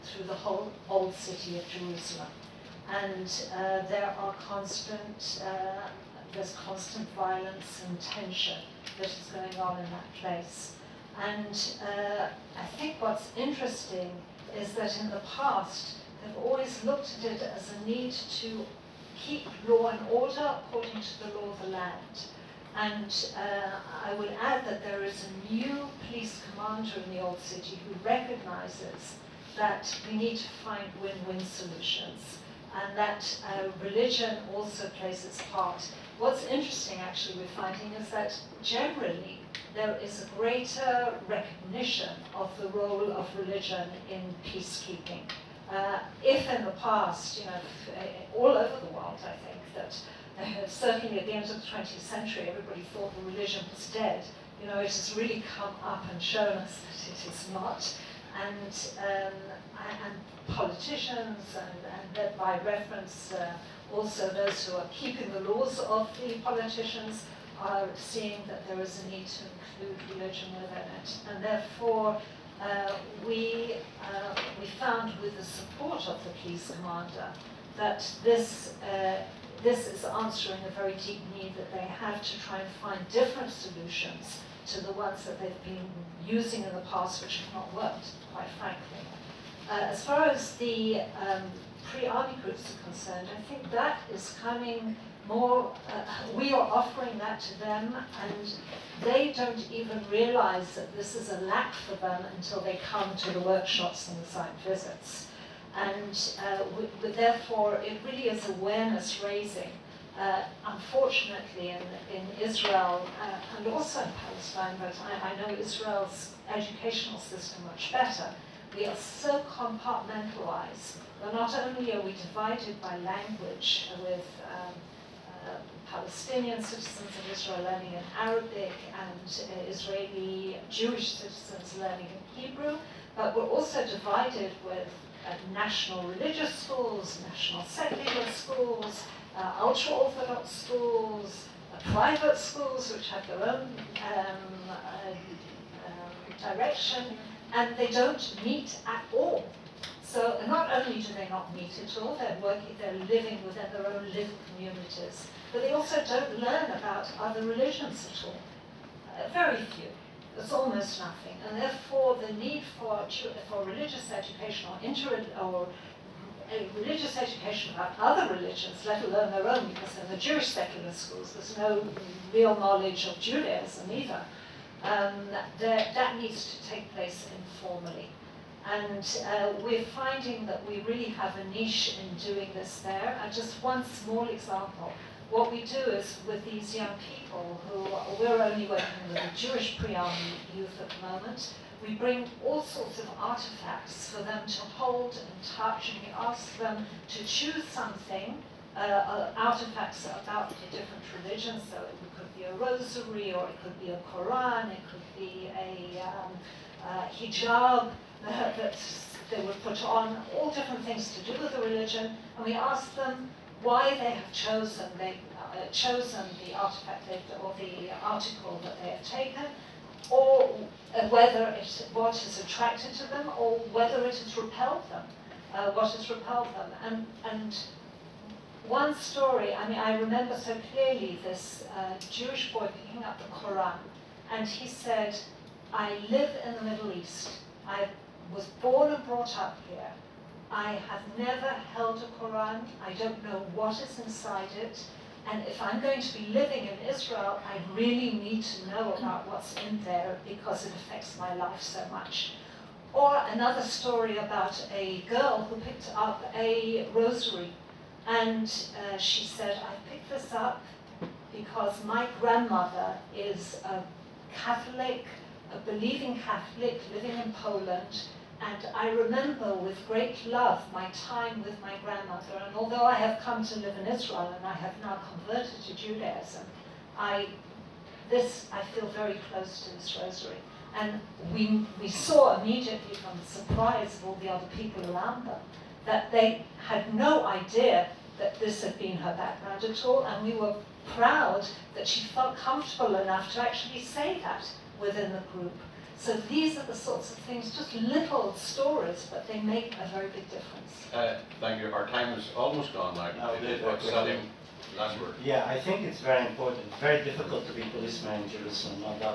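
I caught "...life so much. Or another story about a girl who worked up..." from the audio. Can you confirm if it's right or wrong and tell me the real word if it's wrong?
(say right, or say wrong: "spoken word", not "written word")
wrong: "picked", not "worked".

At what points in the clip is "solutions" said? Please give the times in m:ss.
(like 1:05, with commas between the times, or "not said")
0:31, 1:23.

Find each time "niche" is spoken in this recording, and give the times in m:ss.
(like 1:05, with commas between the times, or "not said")
3:01.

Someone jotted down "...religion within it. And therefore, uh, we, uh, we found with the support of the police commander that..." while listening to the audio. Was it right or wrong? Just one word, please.
right.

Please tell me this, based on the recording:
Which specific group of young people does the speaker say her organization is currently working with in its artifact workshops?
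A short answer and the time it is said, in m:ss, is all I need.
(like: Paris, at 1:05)
Jewish pre-army youth, at 3:09.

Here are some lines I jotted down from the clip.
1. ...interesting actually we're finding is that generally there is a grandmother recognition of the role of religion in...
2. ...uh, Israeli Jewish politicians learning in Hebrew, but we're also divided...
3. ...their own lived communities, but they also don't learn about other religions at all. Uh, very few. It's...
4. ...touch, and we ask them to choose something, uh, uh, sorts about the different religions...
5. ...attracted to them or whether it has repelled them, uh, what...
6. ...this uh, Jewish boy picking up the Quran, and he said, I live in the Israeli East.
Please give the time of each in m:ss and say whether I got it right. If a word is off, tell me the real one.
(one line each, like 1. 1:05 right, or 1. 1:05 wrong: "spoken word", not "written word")
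1. 0:36 wrong: "greater", not "grandmother"
2. 2:09 wrong: "citizens", not "politicians"
3. 2:33 right
4. 3:15 wrong: "artifacts", not "sorts"
5. 3:42 right
6. 3:51 wrong: "Middle", not "Israeli".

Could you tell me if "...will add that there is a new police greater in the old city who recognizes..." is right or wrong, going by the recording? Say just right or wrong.
wrong.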